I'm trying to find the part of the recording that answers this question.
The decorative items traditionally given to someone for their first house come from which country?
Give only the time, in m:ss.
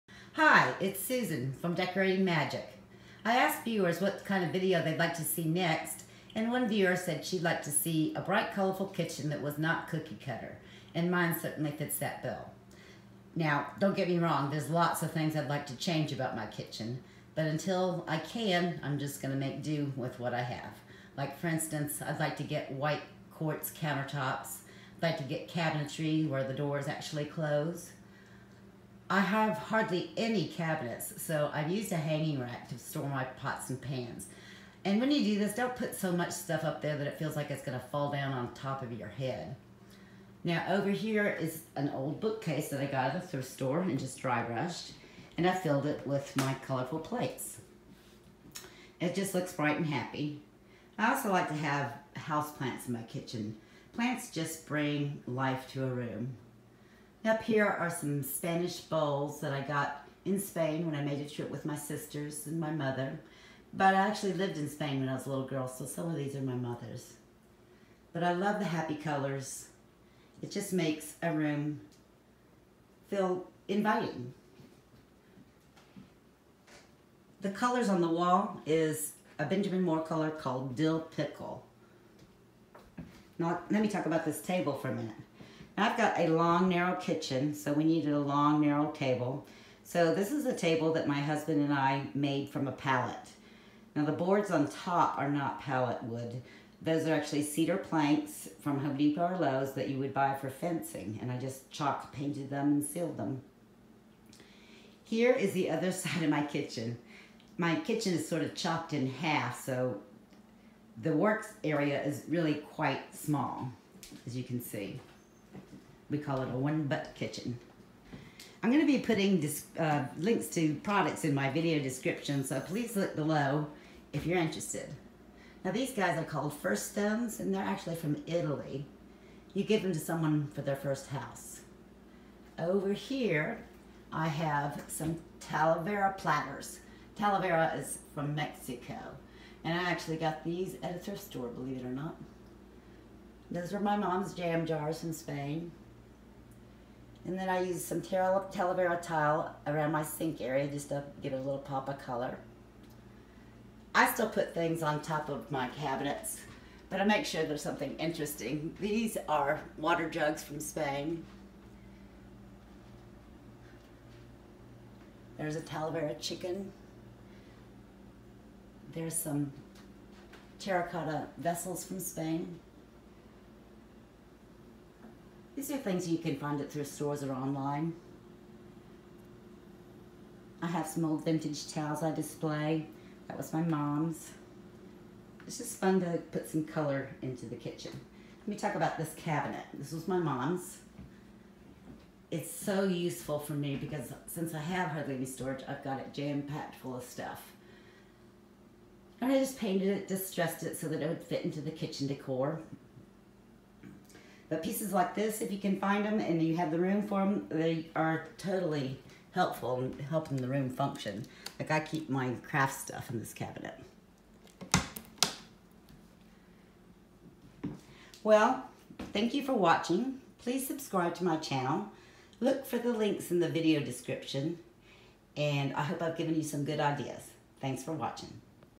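2:08.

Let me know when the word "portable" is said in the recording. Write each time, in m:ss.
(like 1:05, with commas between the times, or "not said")
not said.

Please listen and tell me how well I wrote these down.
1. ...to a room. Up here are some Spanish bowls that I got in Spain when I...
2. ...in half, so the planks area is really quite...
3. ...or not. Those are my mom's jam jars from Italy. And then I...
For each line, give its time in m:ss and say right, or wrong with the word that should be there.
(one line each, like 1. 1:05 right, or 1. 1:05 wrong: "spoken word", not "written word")
1. 0:55 right
2. 1:48 wrong: "works", not "planks"
3. 2:21 wrong: "Spain", not "Italy".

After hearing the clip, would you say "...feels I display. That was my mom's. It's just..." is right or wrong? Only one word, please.
wrong.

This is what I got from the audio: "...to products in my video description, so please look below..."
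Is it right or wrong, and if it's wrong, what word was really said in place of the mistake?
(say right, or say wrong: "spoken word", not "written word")
right.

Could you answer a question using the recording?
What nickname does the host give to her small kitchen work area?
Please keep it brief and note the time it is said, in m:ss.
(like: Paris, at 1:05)
One butt kitchen, at 1:56.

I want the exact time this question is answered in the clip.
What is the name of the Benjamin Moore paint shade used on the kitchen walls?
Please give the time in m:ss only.
1:20.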